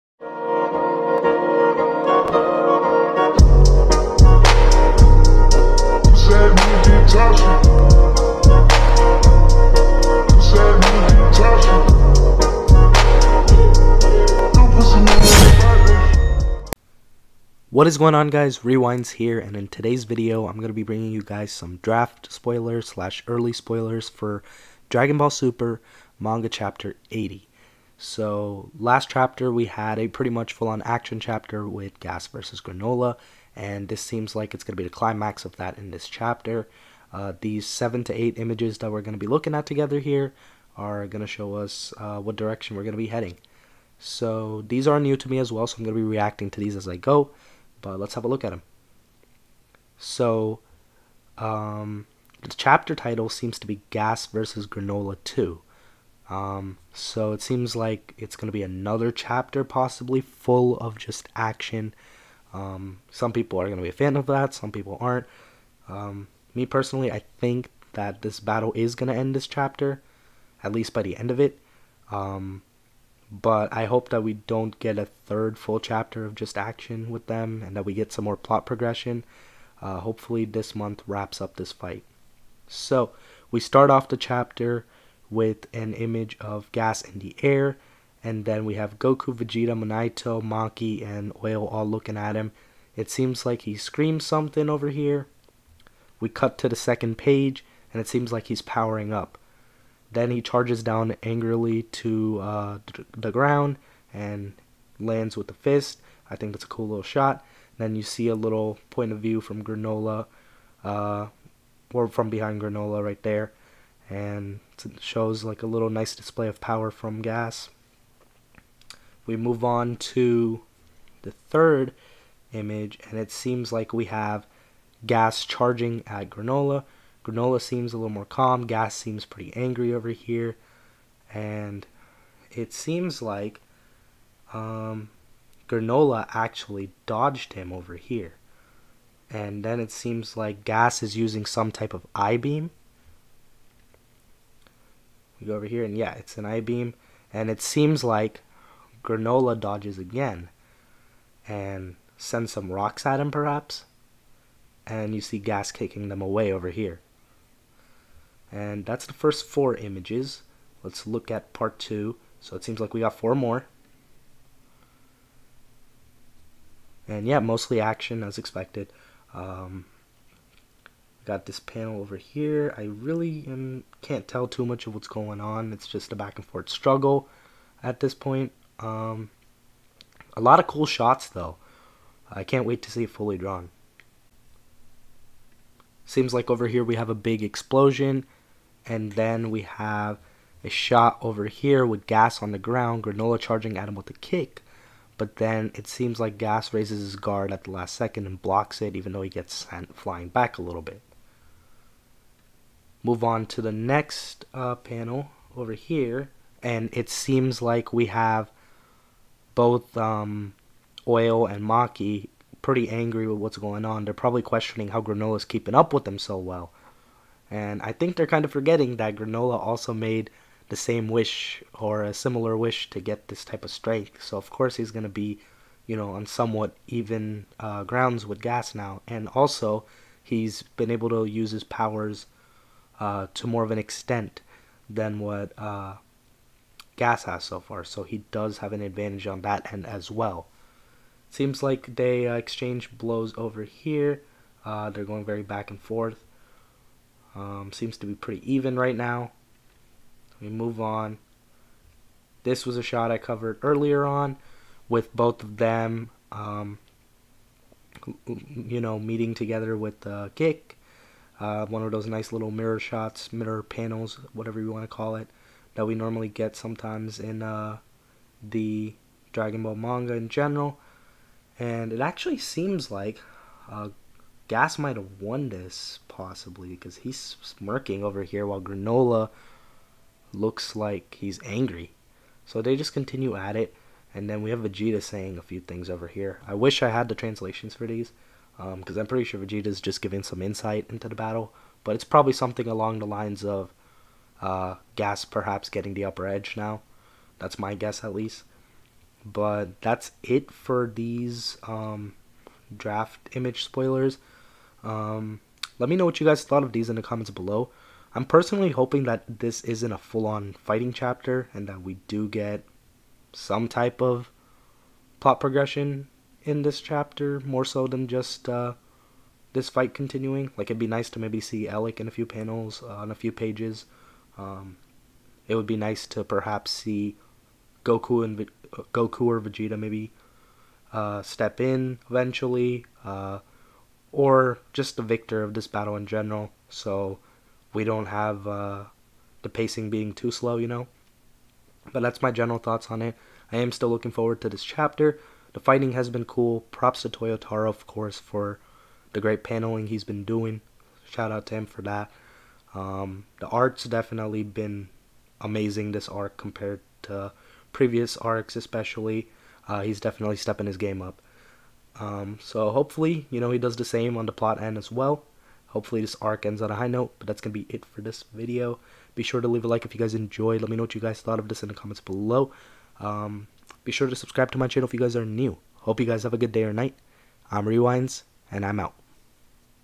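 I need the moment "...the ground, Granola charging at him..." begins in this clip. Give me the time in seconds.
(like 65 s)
192 s.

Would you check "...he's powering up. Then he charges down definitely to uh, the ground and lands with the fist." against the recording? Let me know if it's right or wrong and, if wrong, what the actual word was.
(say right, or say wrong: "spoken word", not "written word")
wrong: "angrily", not "definitely".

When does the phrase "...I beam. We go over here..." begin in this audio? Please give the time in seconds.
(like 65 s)
142 s.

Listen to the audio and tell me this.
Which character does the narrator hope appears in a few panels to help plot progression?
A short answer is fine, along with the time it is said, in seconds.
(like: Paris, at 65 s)
Elec, at 321 s.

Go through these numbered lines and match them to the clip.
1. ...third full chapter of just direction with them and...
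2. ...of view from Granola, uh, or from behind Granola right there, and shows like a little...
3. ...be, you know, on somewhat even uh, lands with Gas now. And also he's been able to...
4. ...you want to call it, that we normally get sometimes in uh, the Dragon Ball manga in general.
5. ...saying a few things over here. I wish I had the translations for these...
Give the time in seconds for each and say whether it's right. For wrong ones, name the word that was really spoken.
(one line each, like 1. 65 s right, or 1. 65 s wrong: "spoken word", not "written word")
1. 75 s wrong: "action", not "direction"
2. 109 s right
3. 225 s wrong: "grounds", not "lands"
4. 264 s right
5. 285 s right.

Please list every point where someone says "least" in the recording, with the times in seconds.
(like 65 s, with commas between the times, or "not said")
70 s, 298 s.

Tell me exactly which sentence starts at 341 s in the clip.
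But that's my general thoughts on it.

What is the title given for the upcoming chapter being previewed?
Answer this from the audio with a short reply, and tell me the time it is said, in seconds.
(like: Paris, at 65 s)
Gas versus Granola 2, at 53 s.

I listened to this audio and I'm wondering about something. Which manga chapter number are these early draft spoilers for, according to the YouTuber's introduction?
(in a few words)
80.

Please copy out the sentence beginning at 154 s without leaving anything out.
And you see Gas kicking them away over here.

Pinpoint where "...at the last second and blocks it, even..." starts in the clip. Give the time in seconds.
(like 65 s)
197 s.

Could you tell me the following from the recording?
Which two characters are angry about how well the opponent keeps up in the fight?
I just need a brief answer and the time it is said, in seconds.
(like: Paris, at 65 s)
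Oil and Maki, at 211 s.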